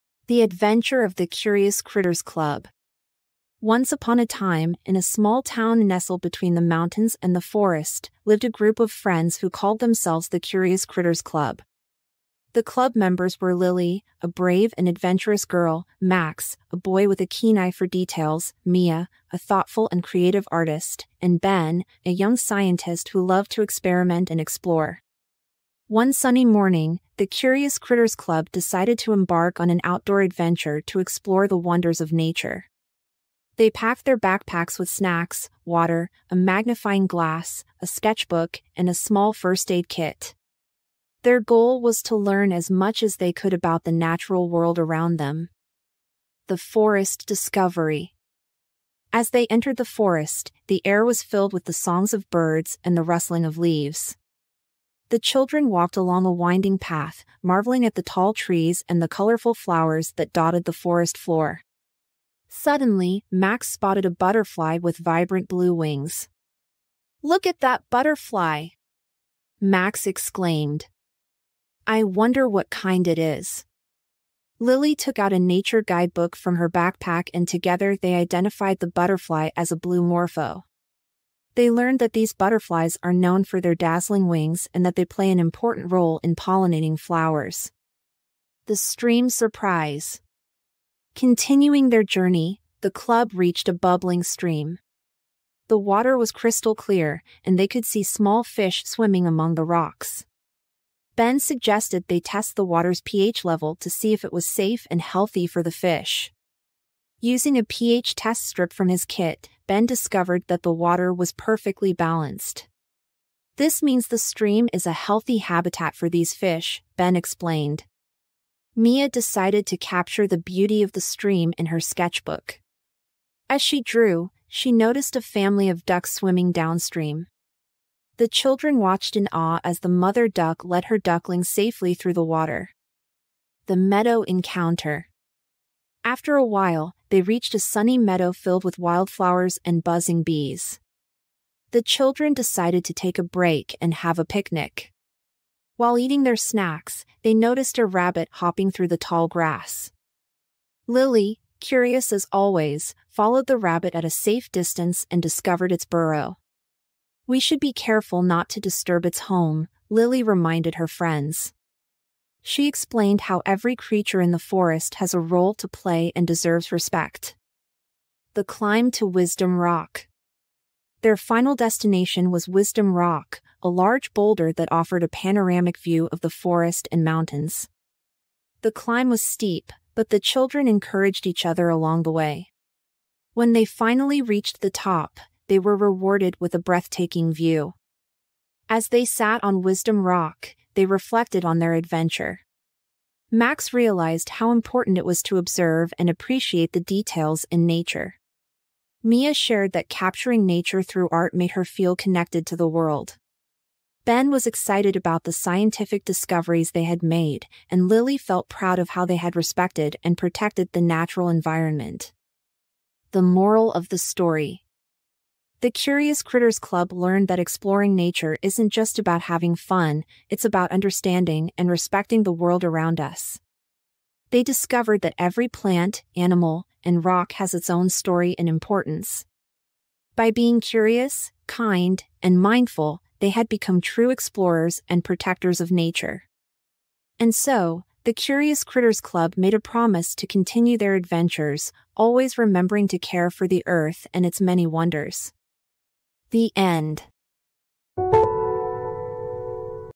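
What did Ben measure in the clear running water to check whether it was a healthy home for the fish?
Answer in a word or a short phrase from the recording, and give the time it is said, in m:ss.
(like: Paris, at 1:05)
pH level, at 1:43.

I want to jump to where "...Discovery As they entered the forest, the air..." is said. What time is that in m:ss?
0:47.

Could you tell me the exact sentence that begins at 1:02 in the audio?
Suddenly, Max spotted a butterfly with vibrant blue wings.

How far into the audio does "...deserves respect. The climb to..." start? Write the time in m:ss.
2:46.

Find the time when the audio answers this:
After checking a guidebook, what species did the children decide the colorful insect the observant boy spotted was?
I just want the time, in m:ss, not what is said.
1:19.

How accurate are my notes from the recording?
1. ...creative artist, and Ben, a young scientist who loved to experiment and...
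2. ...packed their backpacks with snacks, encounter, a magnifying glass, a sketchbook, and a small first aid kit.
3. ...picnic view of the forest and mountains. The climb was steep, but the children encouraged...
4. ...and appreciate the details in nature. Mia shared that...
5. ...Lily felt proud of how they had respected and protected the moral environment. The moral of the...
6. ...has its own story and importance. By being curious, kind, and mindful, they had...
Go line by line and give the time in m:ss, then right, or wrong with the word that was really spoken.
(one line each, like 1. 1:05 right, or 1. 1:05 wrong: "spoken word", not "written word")
1. 0:20 right
2. 0:33 wrong: "water", not "encounter"
3. 2:55 wrong: "panoramic", not "picnic"
4. 3:15 right
5. 3:27 wrong: "natural", not "moral"
6. 3:47 right.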